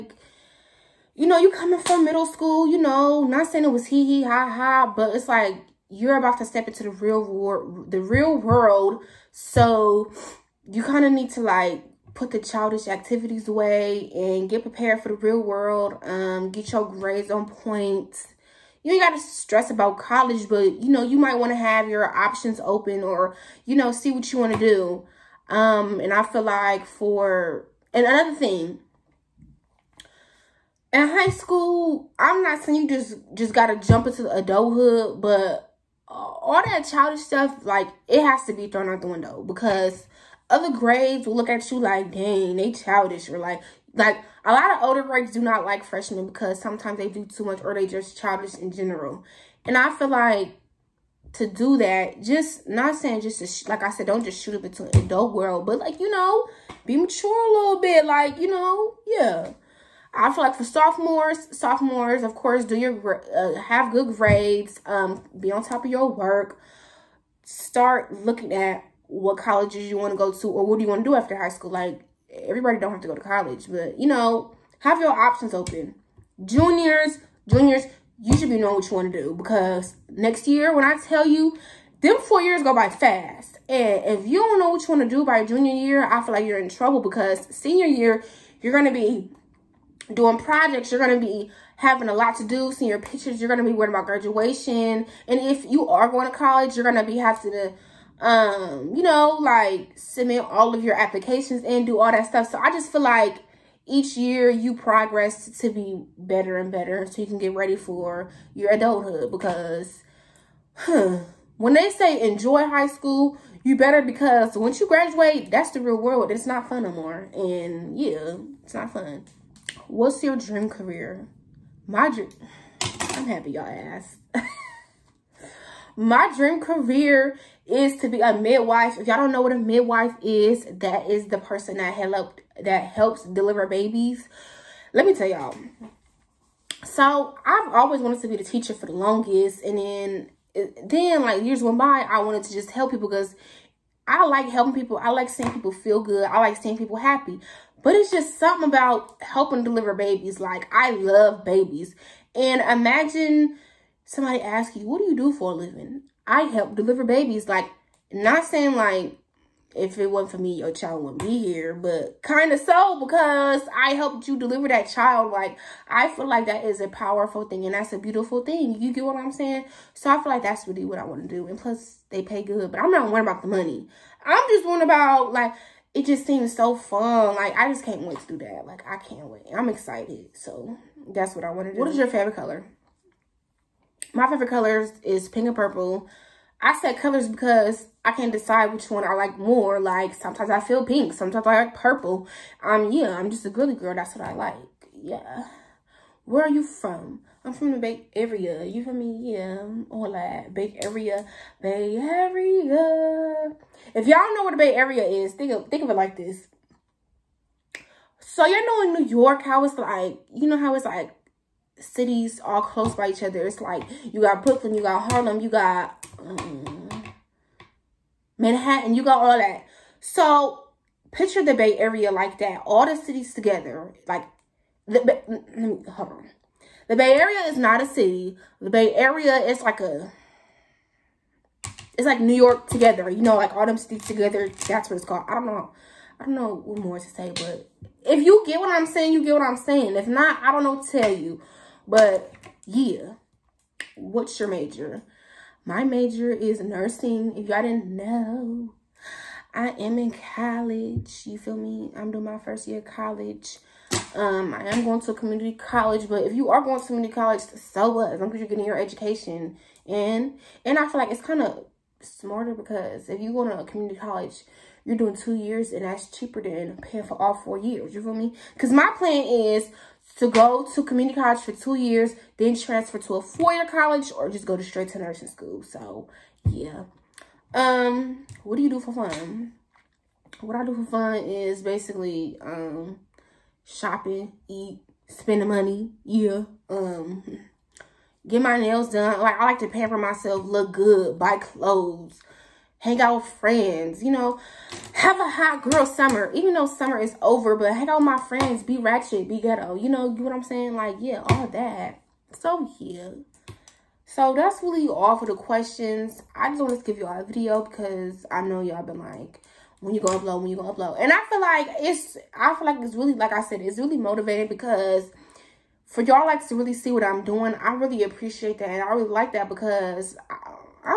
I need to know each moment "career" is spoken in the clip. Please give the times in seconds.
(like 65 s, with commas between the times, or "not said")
120 s, 126 s.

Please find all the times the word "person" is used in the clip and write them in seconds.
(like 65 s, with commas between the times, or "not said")
131 s.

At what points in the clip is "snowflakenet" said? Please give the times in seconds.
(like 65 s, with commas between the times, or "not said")
not said.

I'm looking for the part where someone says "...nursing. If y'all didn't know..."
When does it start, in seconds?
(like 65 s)
246 s.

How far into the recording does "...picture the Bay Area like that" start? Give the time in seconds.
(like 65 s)
221 s.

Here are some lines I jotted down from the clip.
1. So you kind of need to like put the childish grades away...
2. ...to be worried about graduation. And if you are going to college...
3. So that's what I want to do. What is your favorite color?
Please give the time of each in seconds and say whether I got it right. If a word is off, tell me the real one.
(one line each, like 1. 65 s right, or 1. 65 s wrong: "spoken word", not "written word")
1. 9 s wrong: "activities", not "grades"
2. 93 s right
3. 180 s right.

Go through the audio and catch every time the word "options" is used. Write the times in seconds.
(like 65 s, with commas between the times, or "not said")
22 s, 75 s.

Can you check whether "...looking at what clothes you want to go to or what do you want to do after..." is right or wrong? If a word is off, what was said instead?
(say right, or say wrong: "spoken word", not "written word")
wrong: "colleges", not "clothes".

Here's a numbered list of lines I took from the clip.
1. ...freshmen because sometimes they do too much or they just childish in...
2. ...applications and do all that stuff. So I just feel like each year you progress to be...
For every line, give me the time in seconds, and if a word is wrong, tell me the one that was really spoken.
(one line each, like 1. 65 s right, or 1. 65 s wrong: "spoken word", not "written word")
1. 45 s right
2. 100 s right.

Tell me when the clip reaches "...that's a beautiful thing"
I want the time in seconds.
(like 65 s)
167 s.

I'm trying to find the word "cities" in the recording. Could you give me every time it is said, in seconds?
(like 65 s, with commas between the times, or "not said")
211 s, 222 s, 233 s.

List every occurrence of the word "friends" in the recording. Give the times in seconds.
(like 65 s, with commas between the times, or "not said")
293 s, 298 s.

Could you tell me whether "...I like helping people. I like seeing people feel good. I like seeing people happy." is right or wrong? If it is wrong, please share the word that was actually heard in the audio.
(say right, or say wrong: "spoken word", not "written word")
right.